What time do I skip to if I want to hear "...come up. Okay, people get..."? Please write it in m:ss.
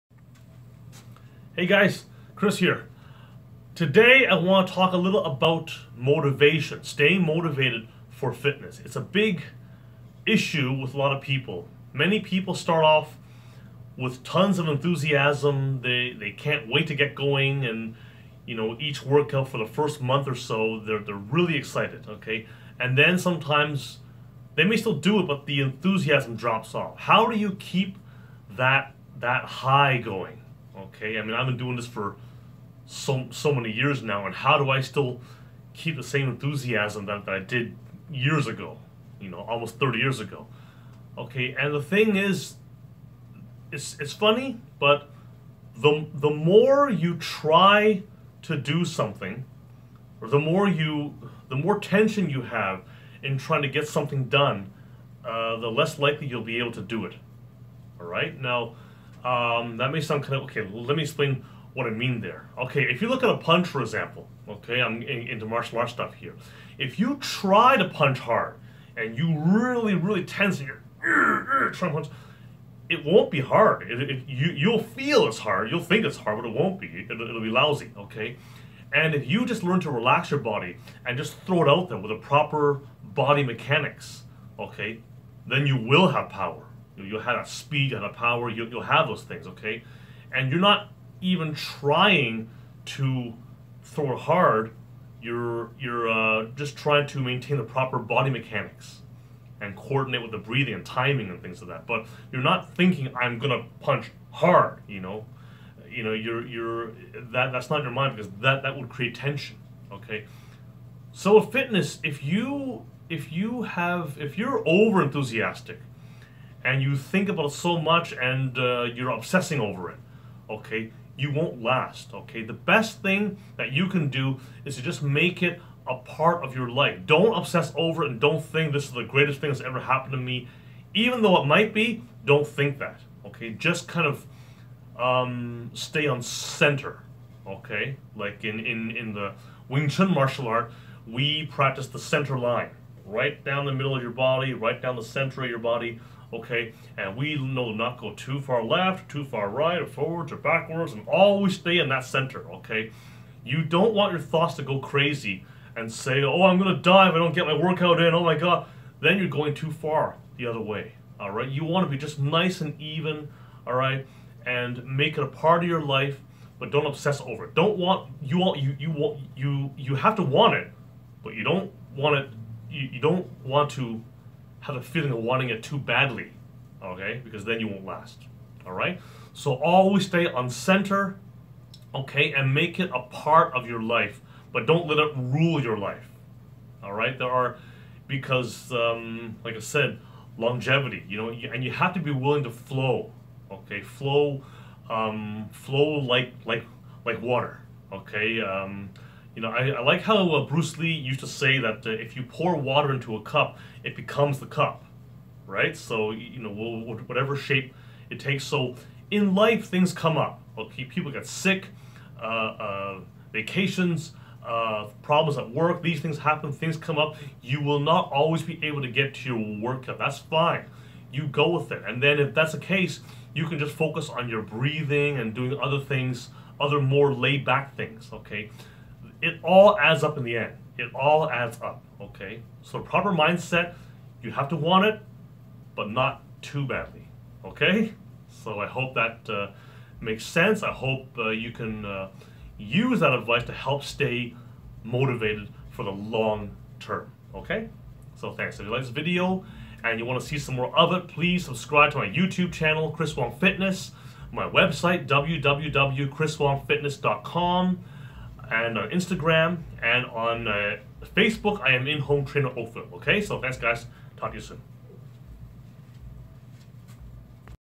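3:29.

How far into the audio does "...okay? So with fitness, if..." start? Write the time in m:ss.
1:49.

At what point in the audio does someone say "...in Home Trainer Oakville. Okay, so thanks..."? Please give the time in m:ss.
4:21.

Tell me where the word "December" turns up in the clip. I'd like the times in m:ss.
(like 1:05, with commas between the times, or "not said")
not said.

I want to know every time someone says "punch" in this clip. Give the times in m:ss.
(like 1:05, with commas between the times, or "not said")
1:03, 1:07, 1:12, 1:43.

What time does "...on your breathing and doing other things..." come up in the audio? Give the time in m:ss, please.
3:44.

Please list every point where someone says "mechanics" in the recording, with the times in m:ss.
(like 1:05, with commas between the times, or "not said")
1:23, 1:38.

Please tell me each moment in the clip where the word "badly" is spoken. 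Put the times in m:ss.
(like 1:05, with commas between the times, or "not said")
2:55, 3:56.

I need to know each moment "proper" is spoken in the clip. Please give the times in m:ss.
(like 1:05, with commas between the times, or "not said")
1:22, 1:37, 3:52.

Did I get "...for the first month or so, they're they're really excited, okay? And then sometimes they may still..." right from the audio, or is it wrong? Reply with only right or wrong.
right.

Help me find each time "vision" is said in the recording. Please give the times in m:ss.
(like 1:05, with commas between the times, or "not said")
not said.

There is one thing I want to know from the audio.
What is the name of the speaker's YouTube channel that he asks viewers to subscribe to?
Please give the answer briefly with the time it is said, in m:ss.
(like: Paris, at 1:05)
Chris Wong Fitness, at 4:12.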